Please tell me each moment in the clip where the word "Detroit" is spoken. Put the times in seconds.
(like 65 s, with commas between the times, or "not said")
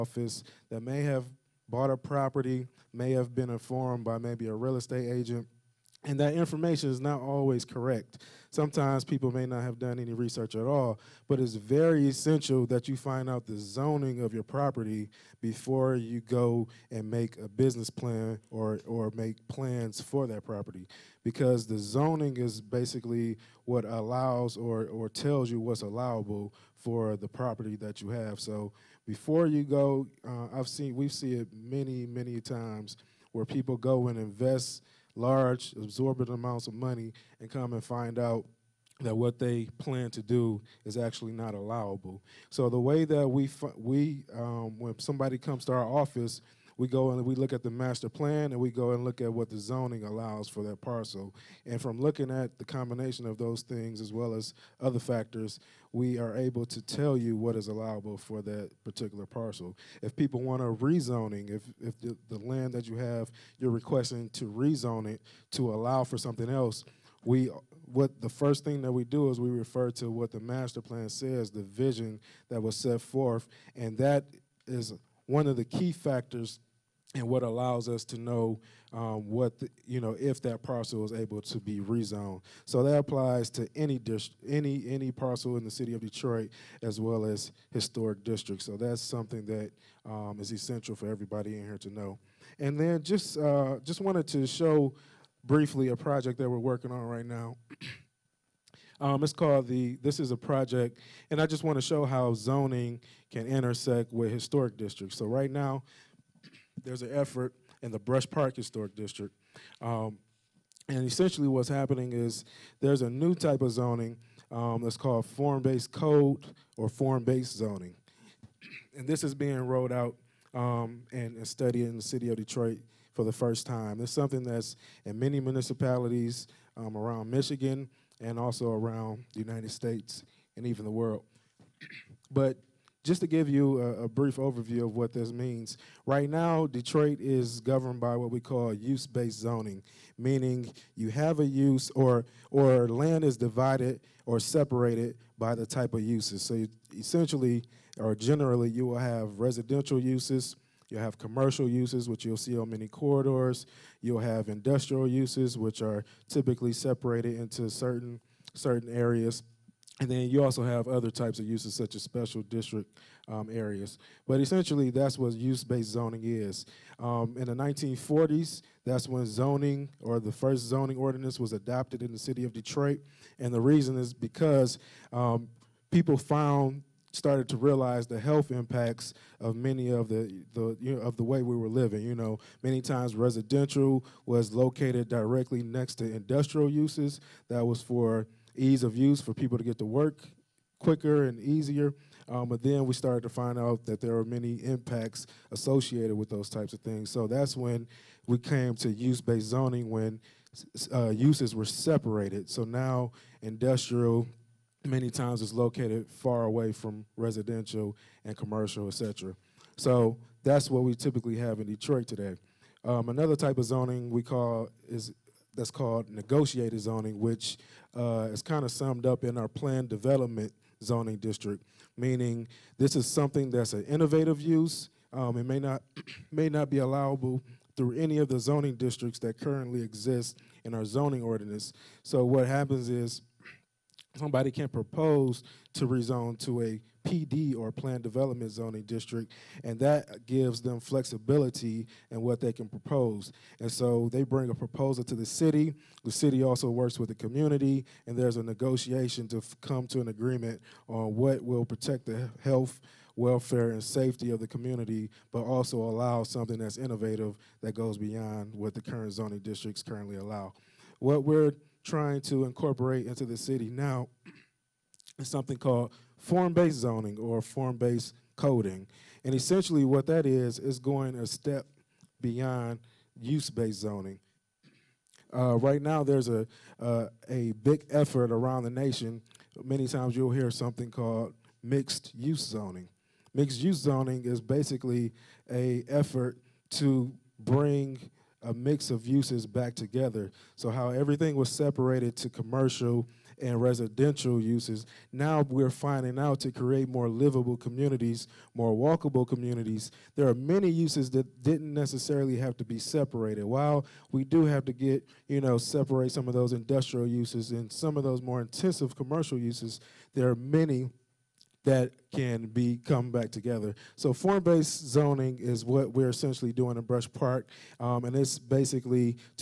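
86 s, 122 s, 136 s, 172 s, 211 s.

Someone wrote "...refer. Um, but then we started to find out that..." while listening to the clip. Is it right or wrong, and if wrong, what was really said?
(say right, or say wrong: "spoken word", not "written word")
wrong: "easier", not "refer".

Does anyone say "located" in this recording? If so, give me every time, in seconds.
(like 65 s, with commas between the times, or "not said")
184 s, 205 s.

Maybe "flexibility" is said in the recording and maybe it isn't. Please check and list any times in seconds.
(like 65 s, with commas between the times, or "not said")
240 s.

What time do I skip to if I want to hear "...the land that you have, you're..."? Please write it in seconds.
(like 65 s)
62 s.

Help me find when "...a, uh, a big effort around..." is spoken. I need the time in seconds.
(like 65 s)
276 s.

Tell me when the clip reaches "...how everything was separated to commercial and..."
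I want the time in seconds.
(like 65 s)
290 s.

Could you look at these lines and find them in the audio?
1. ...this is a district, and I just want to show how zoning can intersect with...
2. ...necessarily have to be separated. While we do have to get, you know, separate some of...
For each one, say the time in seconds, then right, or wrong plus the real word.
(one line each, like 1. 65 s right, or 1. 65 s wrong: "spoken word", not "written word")
1. 100 s wrong: "project", not "district"
2. 301 s right.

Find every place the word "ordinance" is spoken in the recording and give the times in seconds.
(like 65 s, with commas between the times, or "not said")
170 s, 231 s.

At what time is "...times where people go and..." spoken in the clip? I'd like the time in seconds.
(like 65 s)
32 s.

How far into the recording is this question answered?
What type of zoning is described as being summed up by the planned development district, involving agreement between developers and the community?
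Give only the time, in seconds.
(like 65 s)
216 s.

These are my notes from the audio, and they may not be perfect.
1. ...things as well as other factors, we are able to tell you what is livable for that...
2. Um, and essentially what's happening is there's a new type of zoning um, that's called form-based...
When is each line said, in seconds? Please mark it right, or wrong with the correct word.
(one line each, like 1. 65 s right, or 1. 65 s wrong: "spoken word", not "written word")
1. 53 s wrong: "allowable", not "livable"
2. 109 s right.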